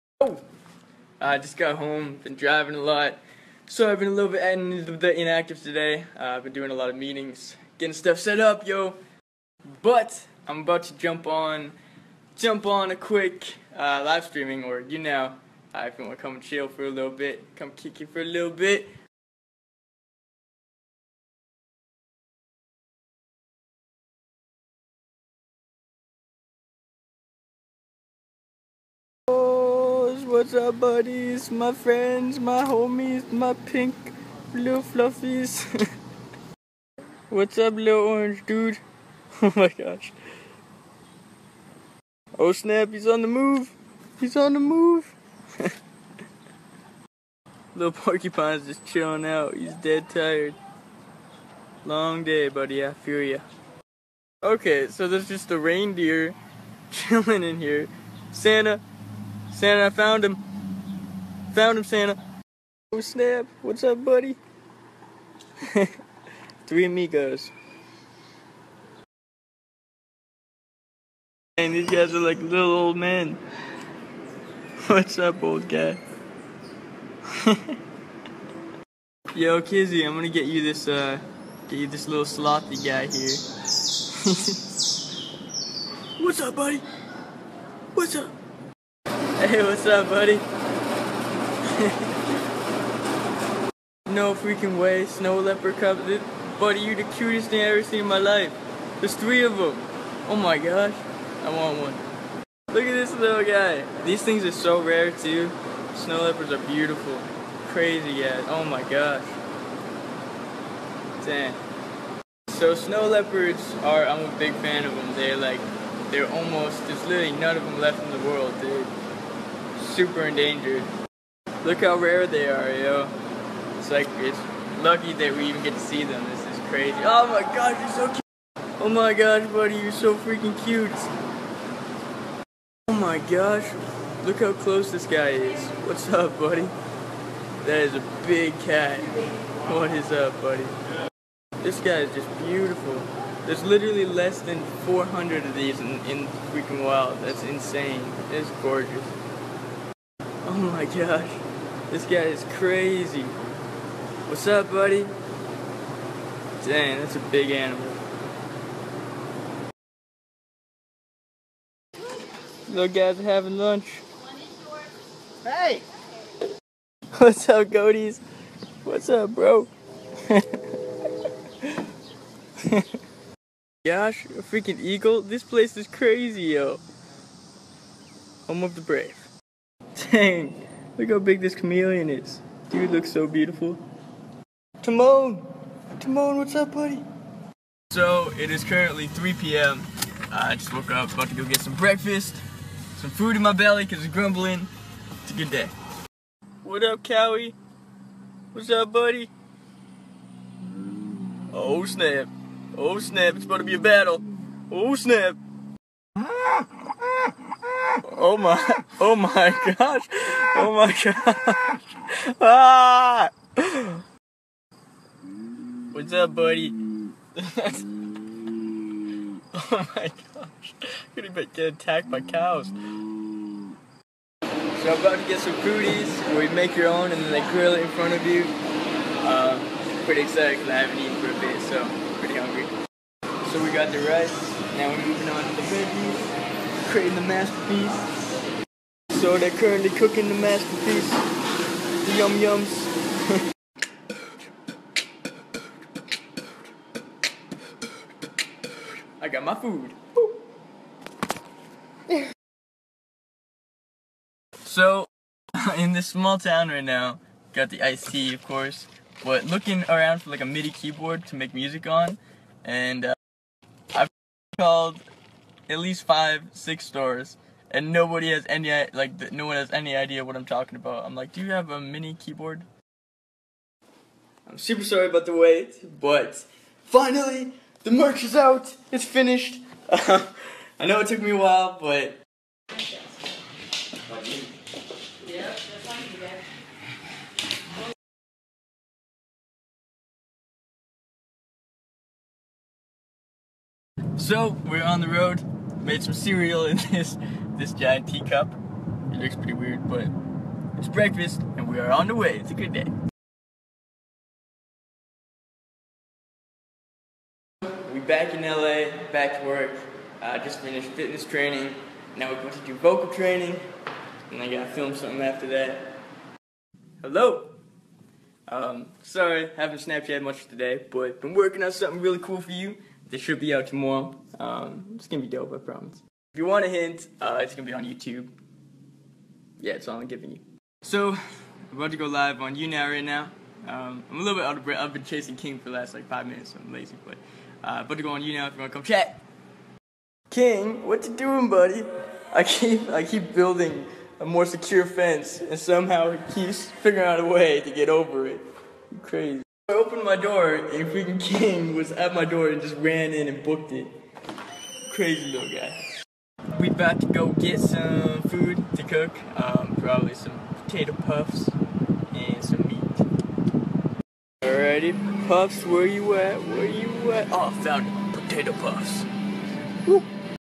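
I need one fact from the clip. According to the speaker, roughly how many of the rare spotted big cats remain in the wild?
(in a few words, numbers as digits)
less than 400.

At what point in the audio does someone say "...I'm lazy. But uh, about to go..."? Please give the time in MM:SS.
05:36.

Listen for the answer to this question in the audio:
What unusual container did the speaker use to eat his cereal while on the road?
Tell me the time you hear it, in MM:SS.
04:57.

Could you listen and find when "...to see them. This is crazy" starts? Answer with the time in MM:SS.
02:05.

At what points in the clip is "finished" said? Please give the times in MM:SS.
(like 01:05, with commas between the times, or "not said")
04:39, 05:10.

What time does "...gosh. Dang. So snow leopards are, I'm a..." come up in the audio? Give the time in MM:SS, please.
01:48.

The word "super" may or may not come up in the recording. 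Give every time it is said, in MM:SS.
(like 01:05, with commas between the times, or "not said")
01:59, 04:34.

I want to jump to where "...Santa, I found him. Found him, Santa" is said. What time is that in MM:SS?
00:59.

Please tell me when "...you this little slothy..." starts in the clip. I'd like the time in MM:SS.
01:21.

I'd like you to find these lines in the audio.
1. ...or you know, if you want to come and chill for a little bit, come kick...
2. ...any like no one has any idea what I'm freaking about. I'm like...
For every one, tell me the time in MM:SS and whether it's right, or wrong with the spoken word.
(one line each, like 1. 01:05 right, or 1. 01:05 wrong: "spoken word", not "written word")
1. 00:14 right
2. 04:28 wrong: "talking", not "freaking".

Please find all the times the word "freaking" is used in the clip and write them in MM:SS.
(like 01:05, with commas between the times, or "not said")
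01:34, 02:10, 02:26, 02:54, 05:50.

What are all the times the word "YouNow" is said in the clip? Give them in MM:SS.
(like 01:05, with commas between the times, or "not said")
05:32, 05:38.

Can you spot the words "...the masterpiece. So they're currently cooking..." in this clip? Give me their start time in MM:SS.
03:57.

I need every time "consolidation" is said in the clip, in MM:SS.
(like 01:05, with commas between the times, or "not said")
not said.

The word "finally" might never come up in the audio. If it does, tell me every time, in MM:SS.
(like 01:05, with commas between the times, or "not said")
04:36.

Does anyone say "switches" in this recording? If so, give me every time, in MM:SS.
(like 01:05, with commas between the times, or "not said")
not said.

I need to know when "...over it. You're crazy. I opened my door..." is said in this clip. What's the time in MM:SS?
05:47.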